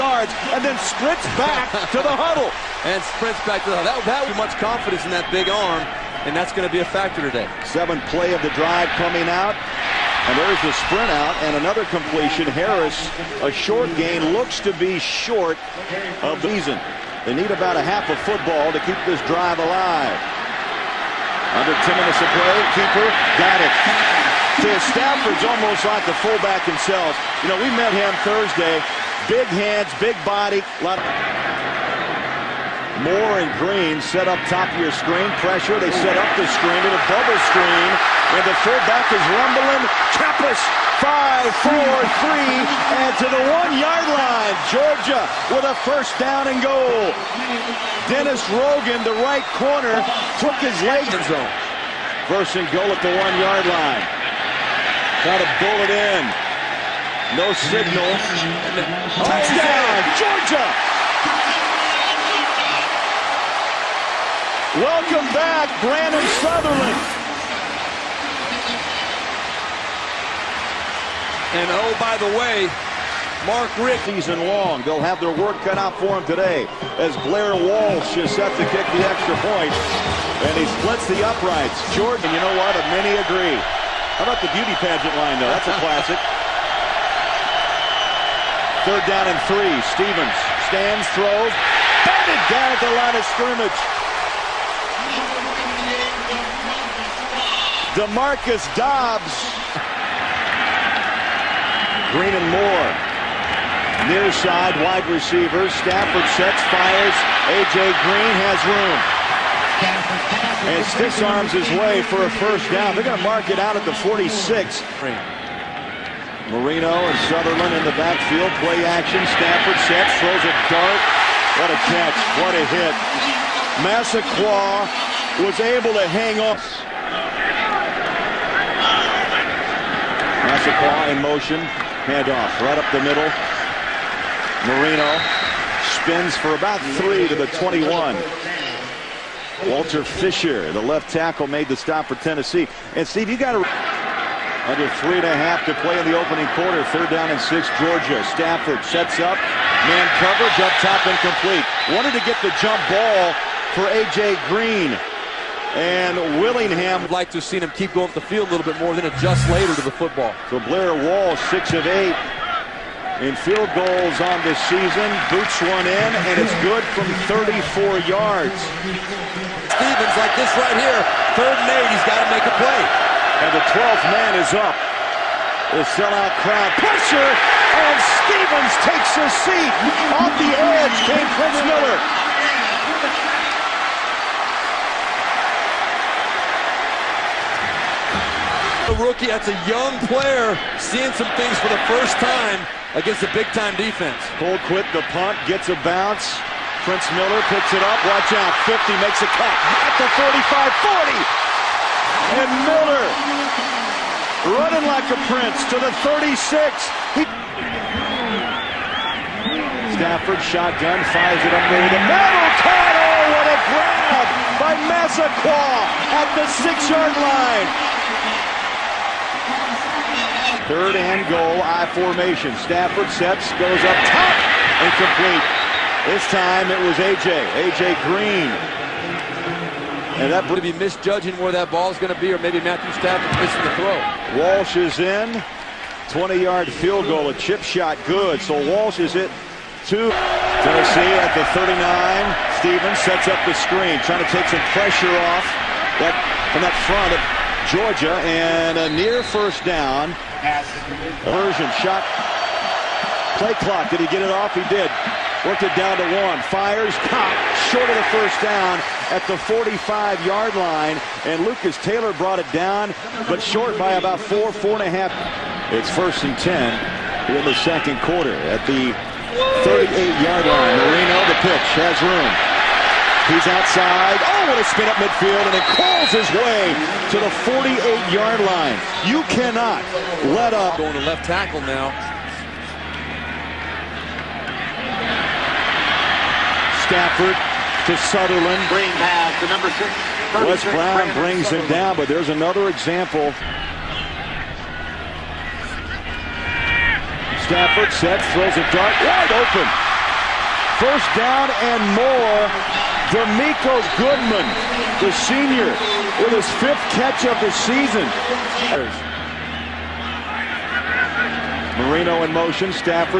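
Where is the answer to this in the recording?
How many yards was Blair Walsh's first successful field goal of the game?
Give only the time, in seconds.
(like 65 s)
167 s.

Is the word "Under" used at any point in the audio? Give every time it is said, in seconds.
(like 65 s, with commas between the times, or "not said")
21 s, 144 s.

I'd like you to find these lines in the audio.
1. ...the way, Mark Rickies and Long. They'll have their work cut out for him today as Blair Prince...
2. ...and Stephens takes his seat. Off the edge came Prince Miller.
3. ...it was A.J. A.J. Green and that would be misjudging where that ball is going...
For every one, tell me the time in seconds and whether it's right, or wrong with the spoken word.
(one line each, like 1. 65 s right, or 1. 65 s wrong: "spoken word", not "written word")
1. 72 s wrong: "Walsh", not "Prince"
2. 177 s right
3. 226 s right.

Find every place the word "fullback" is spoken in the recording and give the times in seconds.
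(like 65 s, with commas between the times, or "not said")
26 s, 38 s.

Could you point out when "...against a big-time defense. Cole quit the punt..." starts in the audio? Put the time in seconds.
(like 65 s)
192 s.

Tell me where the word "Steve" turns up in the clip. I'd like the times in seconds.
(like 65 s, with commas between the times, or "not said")
143 s.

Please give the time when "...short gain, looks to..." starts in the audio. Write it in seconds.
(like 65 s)
13 s.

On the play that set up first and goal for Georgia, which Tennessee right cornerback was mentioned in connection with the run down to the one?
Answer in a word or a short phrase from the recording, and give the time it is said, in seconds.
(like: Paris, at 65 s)
Dennis Rogan, at 48 s.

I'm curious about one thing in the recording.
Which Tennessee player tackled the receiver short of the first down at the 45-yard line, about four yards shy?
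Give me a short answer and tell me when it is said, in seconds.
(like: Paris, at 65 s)
Lucas Taylor, at 261 s.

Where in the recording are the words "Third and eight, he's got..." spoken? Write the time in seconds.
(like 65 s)
171 s.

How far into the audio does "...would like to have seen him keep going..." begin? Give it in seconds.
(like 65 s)
157 s.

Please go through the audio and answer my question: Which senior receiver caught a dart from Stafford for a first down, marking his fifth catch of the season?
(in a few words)
Demiko Goodman.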